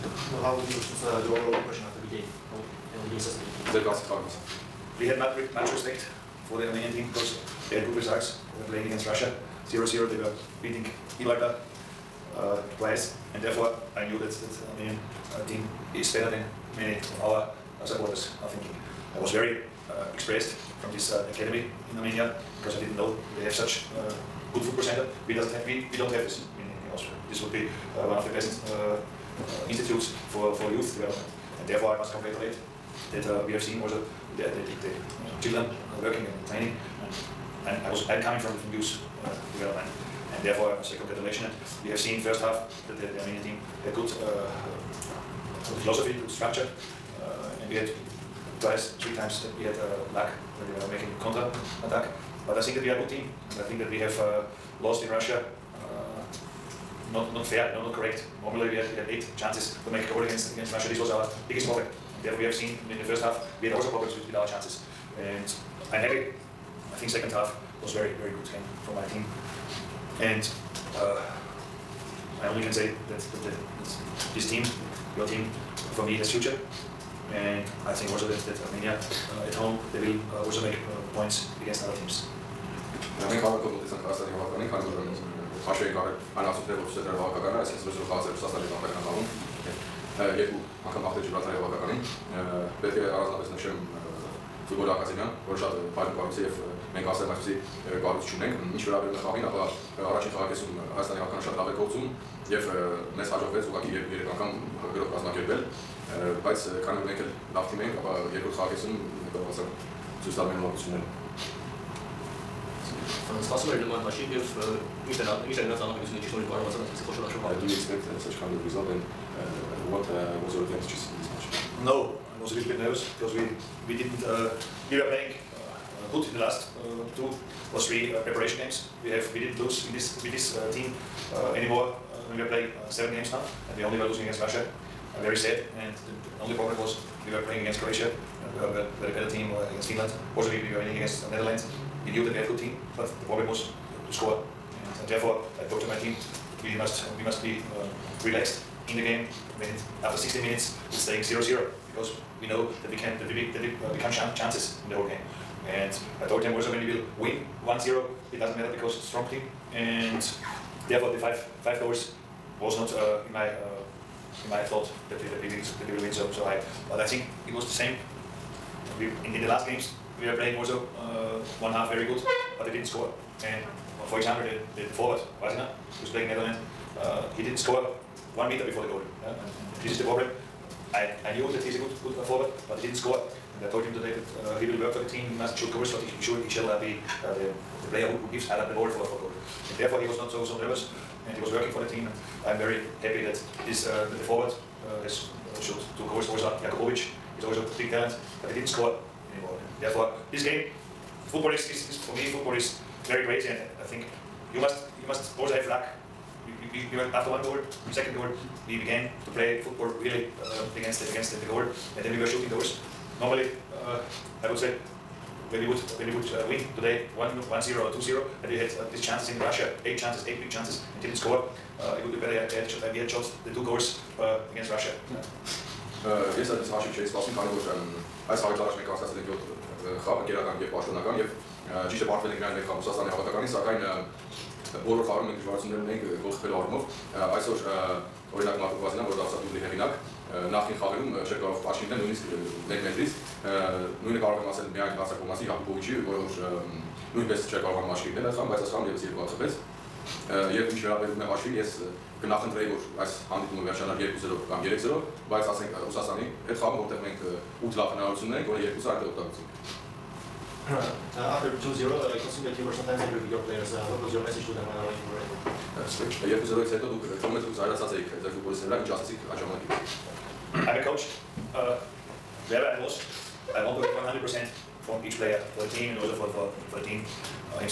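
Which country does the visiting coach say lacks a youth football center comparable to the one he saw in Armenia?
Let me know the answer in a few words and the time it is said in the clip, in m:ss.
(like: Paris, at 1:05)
Austria, at 0:26.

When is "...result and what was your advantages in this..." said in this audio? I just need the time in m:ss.
1:58.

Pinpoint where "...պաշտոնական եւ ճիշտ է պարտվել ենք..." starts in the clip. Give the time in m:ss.
3:50.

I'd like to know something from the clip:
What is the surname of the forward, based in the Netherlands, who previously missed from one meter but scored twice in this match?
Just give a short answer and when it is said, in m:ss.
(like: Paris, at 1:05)
Kvasina, at 2:55.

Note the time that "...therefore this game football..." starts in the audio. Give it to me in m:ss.
3:19.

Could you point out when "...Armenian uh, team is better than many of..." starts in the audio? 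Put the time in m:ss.
0:14.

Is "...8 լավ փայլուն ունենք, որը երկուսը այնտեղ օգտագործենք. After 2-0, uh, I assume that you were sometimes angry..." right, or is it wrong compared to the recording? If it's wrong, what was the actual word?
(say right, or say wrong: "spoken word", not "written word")
wrong: "հնարավորություն", not "փայլուն".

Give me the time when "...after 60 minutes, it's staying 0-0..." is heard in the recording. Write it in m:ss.
2:30.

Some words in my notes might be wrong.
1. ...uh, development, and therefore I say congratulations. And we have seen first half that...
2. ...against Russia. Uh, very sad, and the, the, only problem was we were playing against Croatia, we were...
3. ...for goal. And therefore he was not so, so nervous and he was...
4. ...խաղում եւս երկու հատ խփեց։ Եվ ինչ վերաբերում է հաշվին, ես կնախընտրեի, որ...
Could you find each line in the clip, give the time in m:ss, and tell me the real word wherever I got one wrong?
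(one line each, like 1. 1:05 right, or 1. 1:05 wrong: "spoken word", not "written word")
1. 0:39 right
2. 2:14 right
3. 3:09 right
4. 4:08 right.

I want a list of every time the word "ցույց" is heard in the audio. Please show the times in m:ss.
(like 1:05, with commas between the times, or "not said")
1:26, 1:50.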